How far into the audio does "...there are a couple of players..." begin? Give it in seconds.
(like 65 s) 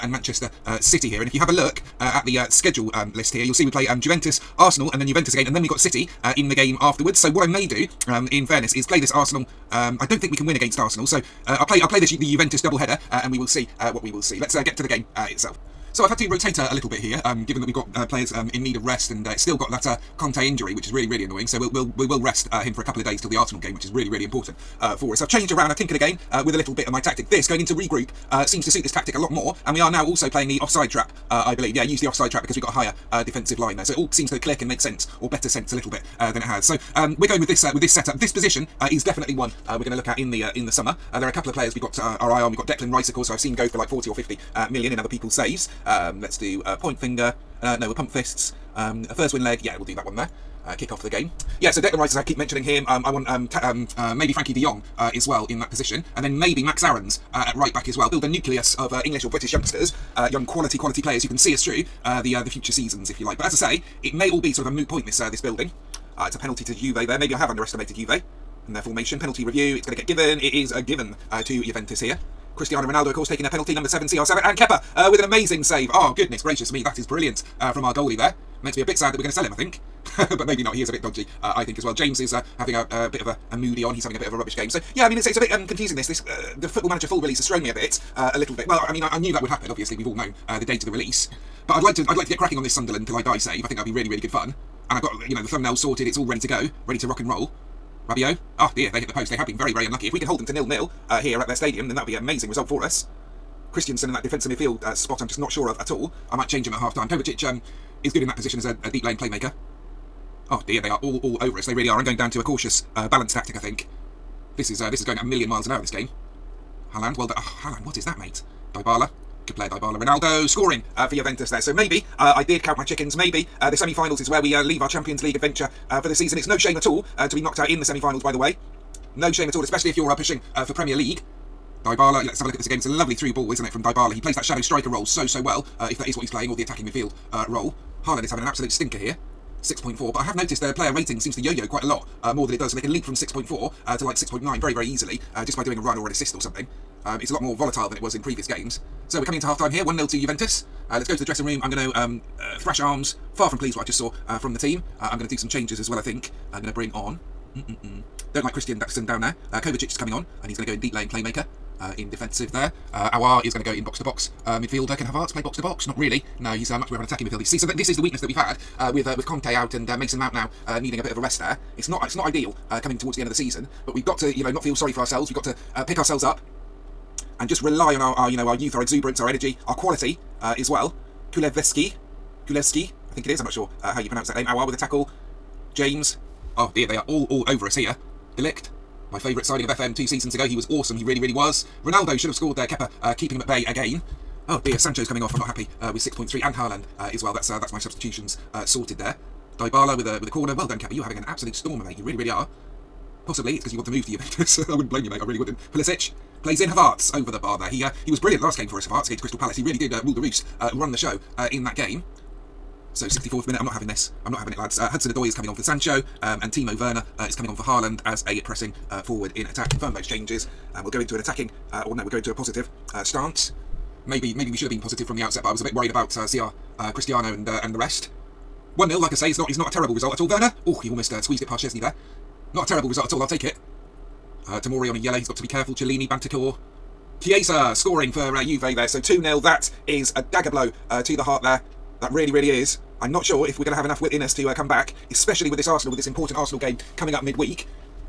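41 s.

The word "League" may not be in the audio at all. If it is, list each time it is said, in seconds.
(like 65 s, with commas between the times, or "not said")
125 s, 130 s.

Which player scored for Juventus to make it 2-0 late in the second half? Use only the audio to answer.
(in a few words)
Chiesa.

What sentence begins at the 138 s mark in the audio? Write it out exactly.
Haaland is having an absolute stinker here.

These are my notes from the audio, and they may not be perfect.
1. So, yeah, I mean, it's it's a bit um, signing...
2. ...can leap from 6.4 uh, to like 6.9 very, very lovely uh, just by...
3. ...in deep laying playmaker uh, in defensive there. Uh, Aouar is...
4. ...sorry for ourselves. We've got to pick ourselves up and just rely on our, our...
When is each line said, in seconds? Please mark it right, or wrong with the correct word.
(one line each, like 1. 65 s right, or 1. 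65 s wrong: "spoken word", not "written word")
1. 84 s wrong: "confusing", not "signing"
2. 142 s wrong: "easily", not "lovely"
3. 160 s right
4. 174 s right.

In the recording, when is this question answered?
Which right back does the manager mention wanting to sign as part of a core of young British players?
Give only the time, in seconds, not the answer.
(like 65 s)
56 s.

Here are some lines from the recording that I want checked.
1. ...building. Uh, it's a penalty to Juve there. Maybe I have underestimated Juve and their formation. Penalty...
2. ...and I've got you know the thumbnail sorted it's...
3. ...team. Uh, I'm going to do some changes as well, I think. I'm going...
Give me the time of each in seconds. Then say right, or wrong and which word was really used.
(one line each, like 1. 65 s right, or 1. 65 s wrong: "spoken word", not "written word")
1. 65 s right
2. 94 s right
3. 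154 s right.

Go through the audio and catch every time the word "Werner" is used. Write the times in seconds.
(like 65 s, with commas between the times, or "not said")
216 s, 230 s.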